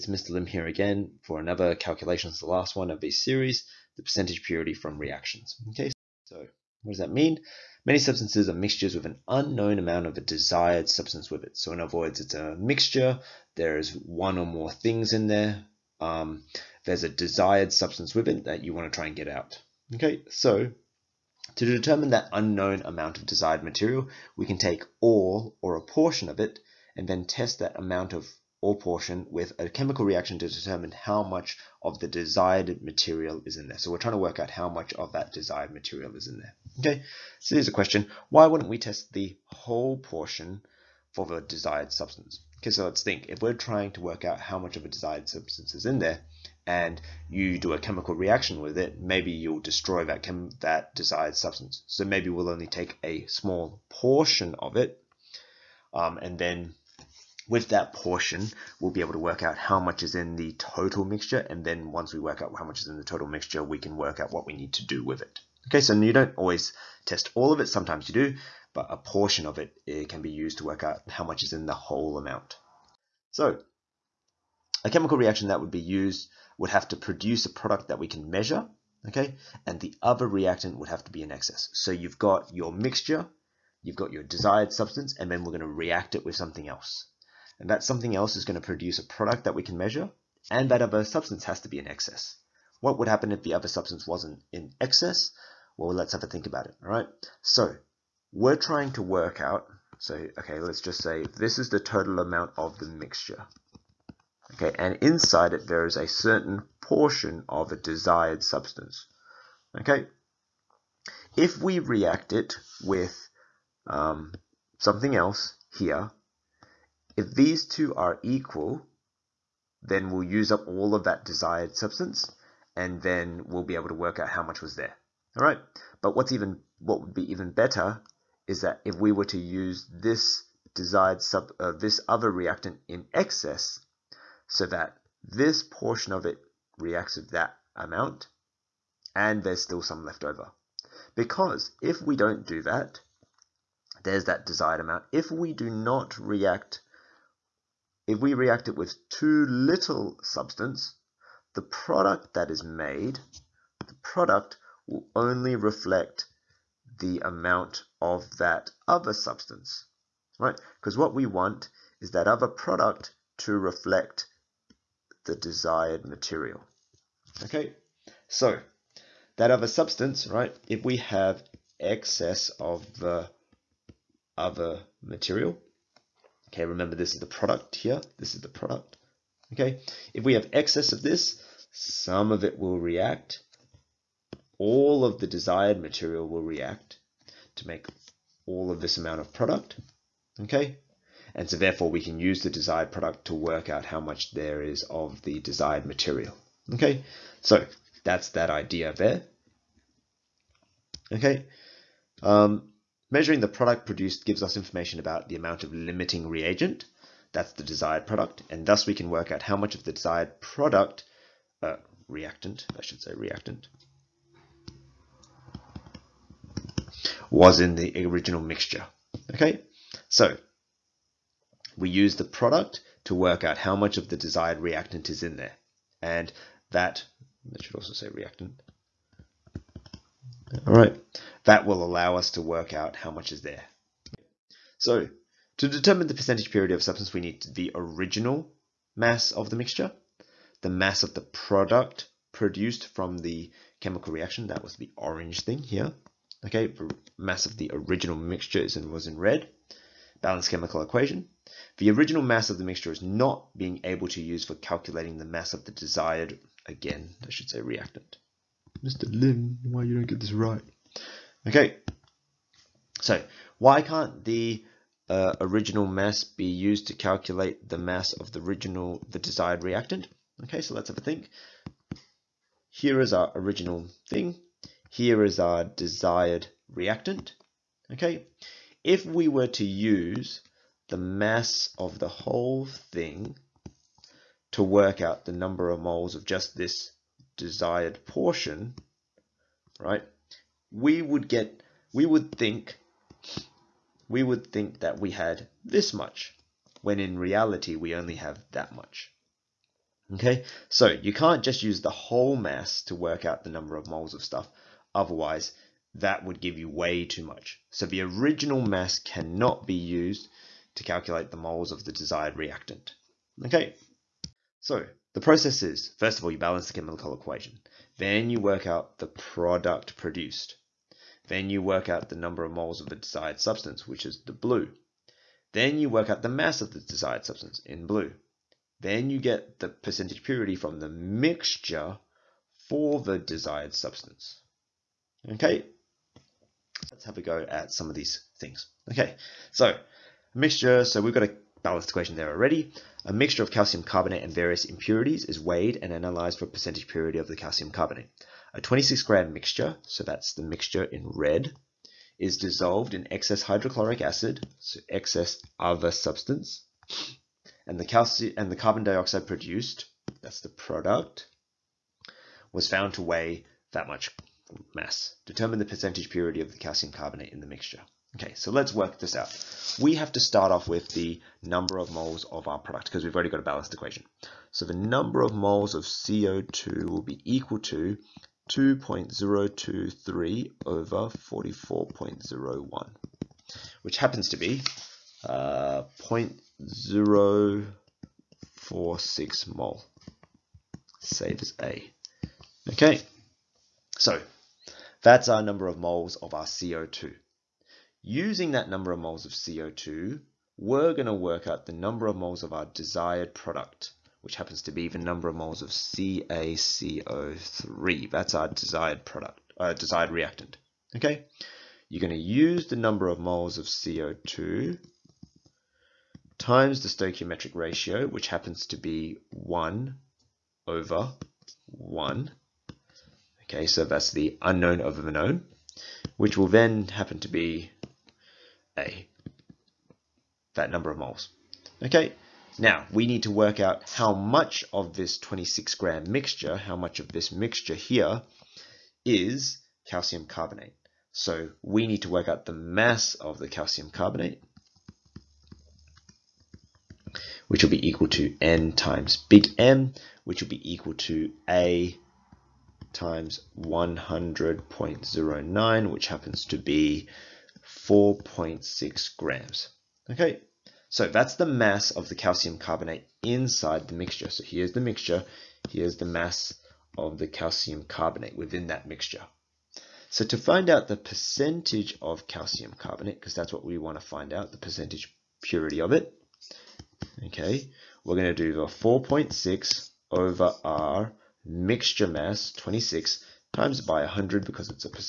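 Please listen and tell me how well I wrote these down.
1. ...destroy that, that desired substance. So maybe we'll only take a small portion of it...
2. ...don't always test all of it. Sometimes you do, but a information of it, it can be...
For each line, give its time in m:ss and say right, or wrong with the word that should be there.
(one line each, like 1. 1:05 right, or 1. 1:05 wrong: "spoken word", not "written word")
1. 0:49 right
2. 1:06 wrong: "portion", not "information".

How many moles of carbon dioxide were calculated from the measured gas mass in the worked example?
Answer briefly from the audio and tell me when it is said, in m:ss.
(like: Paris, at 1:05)
0.046 mole, at 6:26.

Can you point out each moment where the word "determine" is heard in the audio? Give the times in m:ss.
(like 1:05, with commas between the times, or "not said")
0:21, 0:30, 3:55, 6:05.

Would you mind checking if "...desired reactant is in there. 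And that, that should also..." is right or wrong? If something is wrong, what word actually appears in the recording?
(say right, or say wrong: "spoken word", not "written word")
right.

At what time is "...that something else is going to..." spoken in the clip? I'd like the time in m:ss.
1:27.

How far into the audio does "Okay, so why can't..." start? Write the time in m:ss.
4:21.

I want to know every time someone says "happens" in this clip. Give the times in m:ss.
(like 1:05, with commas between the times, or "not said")
1:33, 6:23, 6:44, 6:58, 7:06, 7:36.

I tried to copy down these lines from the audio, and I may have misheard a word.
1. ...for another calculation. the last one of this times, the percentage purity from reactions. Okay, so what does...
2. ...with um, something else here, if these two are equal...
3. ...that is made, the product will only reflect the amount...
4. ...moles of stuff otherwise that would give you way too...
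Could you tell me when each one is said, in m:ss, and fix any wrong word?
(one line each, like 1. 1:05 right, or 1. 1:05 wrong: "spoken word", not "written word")
1. 0:01 wrong: "series", not "times"
2. 1:52 right
3. 2:32 right
4. 5:03 right.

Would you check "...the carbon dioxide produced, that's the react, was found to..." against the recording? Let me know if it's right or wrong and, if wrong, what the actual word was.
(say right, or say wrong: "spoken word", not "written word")
wrong: "product", not "react".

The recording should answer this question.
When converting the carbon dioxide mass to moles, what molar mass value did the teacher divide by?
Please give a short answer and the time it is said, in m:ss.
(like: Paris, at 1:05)
44.01, at 6:21.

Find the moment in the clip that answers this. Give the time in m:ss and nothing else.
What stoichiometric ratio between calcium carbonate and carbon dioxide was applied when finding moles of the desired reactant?
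6:59.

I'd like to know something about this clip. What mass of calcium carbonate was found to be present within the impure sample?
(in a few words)
4.6 grams.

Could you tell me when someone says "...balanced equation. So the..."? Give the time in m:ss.
6:13.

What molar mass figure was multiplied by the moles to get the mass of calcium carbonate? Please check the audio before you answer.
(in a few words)
100.09.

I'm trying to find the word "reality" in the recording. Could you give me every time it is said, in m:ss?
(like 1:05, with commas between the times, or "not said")
4:57.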